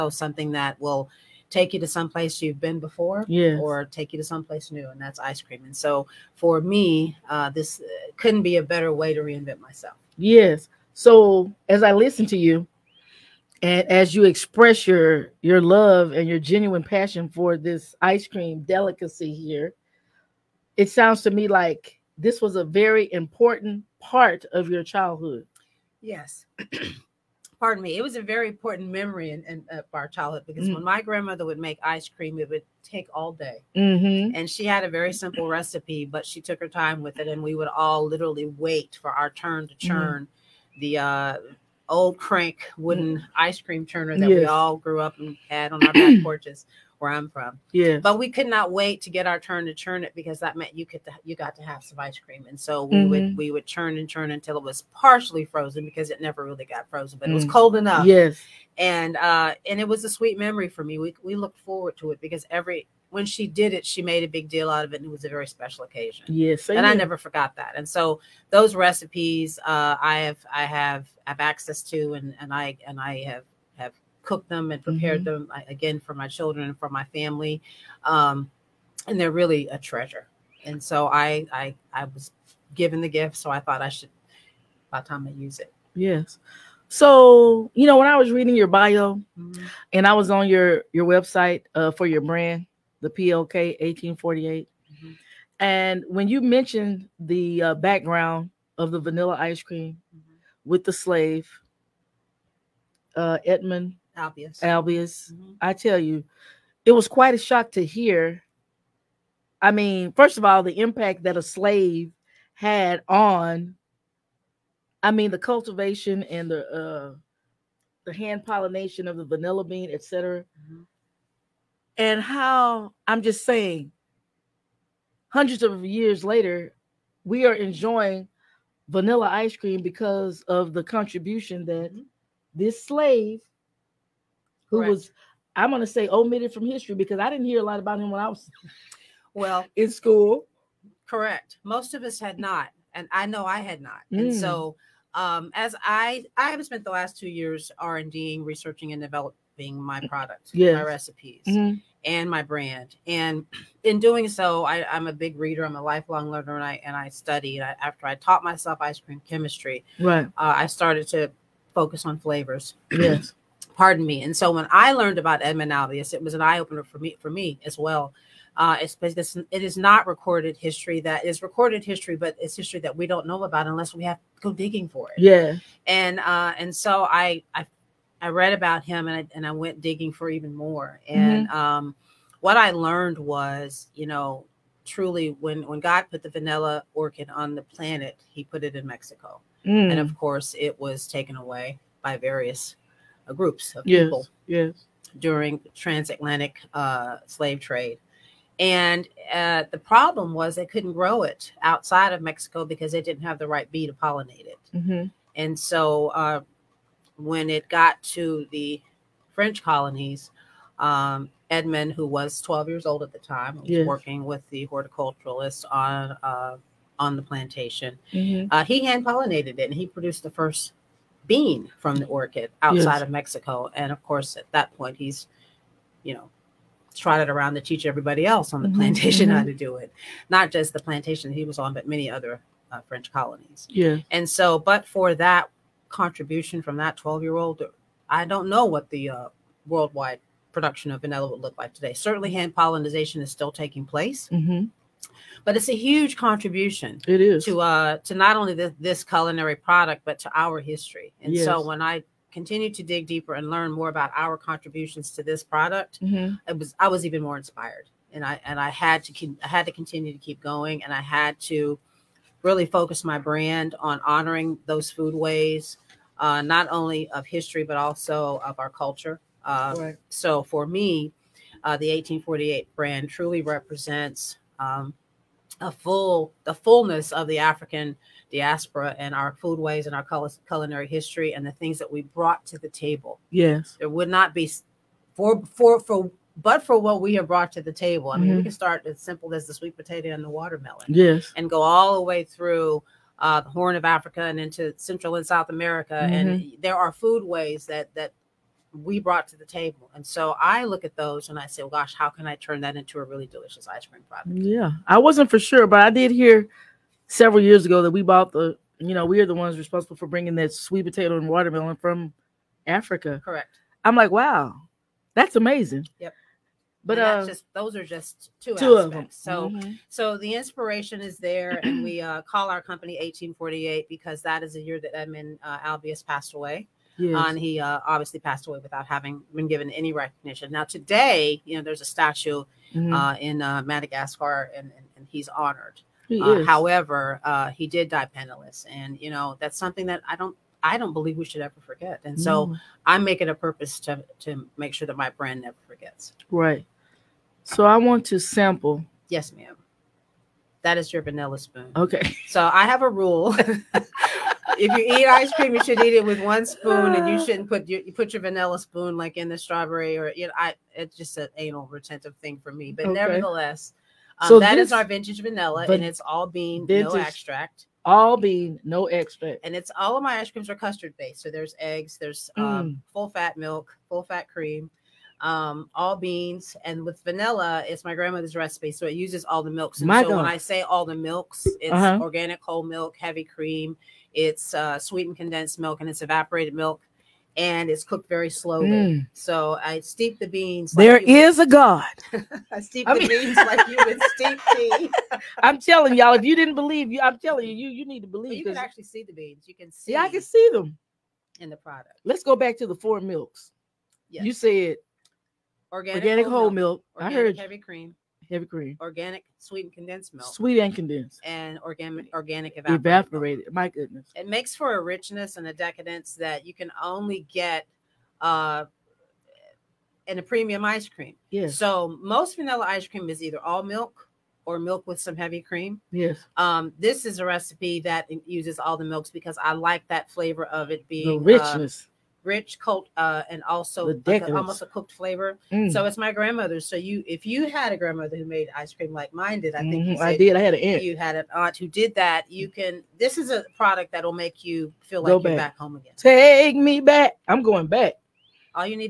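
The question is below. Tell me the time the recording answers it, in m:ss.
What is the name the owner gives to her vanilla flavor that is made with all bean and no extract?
6:04.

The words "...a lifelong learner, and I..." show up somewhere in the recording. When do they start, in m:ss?
2:35.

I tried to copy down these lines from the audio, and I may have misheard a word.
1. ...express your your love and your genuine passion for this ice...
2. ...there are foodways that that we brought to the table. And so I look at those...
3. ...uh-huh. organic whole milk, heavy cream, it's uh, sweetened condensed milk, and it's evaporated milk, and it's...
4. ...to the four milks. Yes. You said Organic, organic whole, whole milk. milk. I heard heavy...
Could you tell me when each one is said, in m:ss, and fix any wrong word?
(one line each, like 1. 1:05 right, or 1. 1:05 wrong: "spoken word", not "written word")
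1. 0:14 right
2. 4:56 right
3. 6:21 right
4. 6:42 right.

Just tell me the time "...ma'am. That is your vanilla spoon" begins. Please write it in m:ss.
5:49.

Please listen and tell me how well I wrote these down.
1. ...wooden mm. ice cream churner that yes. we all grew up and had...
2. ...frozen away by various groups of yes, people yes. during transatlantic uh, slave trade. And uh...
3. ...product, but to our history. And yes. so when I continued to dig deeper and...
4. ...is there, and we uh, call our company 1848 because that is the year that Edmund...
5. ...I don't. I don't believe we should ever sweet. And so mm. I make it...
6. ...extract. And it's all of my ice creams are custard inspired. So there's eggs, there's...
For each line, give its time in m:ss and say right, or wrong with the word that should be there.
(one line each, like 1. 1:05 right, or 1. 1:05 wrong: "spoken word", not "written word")
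1. 0:42 right
2. 3:11 wrong: "taken", not "frozen"
3. 4:09 right
4. 5:21 right
5. 5:40 wrong: "forget", not "sweet"
6. 6:08 wrong: "based", not "inspired".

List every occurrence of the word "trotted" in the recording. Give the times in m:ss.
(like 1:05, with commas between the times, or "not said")
3:46.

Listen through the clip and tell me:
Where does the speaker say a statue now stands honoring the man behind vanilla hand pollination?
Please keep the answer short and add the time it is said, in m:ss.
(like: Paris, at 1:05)
Madagascar, at 5:33.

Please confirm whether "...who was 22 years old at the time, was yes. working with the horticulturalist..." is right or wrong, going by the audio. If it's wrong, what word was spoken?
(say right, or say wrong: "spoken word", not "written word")
wrong: "12", not "22".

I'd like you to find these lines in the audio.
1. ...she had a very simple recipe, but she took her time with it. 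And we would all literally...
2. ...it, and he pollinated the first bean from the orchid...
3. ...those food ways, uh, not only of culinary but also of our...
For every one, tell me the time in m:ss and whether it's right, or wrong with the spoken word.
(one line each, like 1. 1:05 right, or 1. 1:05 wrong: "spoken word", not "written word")
1. 0:34 right
2. 3:39 wrong: "produced", not "pollinated"
3. 4:24 wrong: "history", not "culinary".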